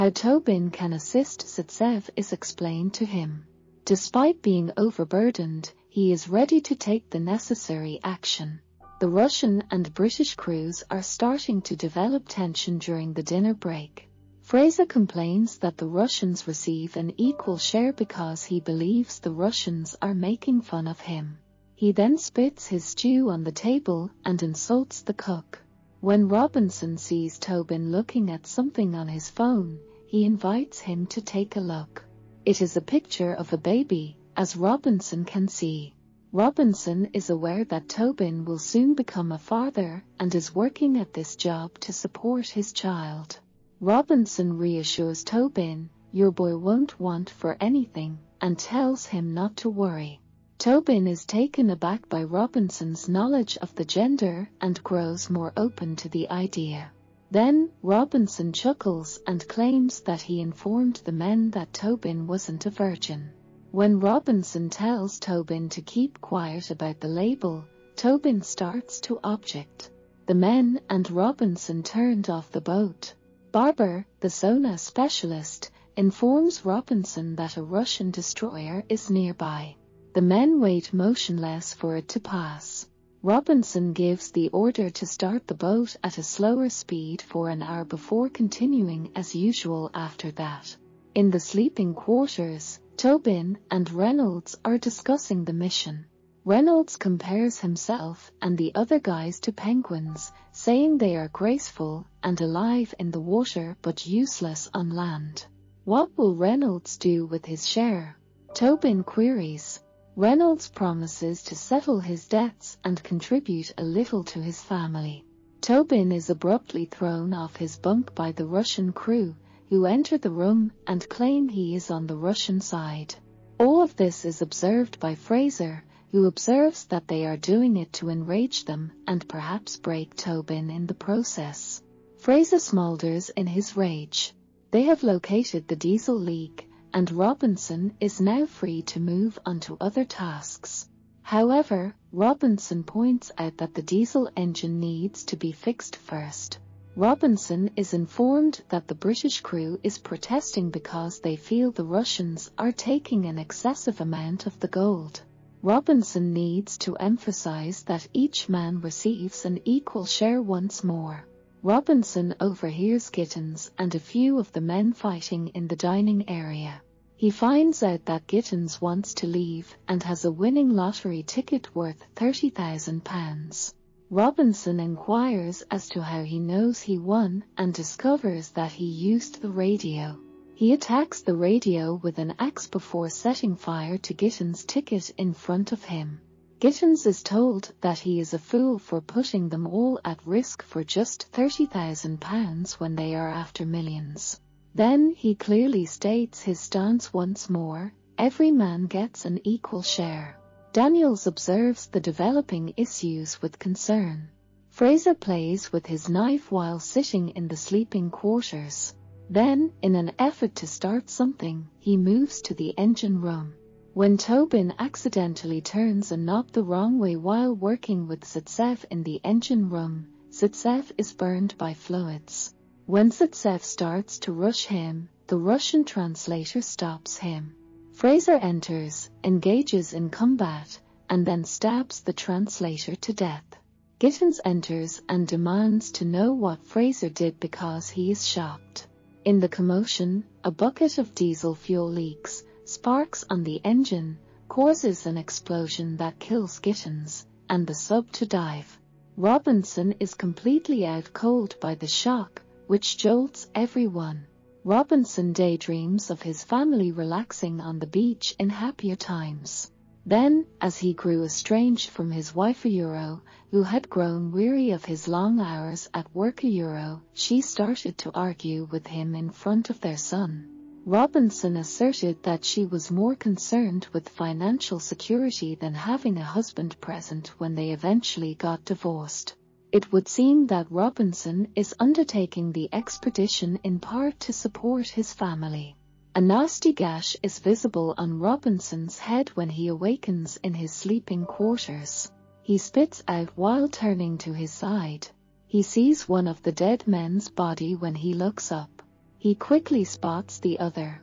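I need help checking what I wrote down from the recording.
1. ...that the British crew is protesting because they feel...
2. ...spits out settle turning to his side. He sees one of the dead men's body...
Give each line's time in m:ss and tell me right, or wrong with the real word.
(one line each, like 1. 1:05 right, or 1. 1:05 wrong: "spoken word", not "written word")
1. 2:28 right
2. 4:52 wrong: "while", not "settle".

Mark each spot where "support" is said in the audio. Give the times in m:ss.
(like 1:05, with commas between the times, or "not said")
0:41, 4:44.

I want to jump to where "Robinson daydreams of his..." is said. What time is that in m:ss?
4:14.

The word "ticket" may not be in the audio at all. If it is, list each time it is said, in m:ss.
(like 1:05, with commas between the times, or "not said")
2:51, 3:04.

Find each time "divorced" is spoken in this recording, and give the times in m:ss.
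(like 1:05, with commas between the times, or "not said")
4:38.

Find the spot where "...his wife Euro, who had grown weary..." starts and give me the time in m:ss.
4:22.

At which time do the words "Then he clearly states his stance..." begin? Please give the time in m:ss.
3:14.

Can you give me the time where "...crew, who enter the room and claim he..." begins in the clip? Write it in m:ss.
1:58.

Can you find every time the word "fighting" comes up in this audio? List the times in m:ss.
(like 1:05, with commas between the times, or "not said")
2:44.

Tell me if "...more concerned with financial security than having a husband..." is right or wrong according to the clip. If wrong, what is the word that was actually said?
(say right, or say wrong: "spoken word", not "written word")
right.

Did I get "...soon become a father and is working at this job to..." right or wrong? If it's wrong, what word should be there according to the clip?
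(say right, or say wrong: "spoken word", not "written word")
right.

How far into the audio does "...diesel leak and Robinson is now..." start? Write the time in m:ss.
2:15.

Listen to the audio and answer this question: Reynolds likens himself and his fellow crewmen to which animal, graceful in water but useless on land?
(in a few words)
penguins.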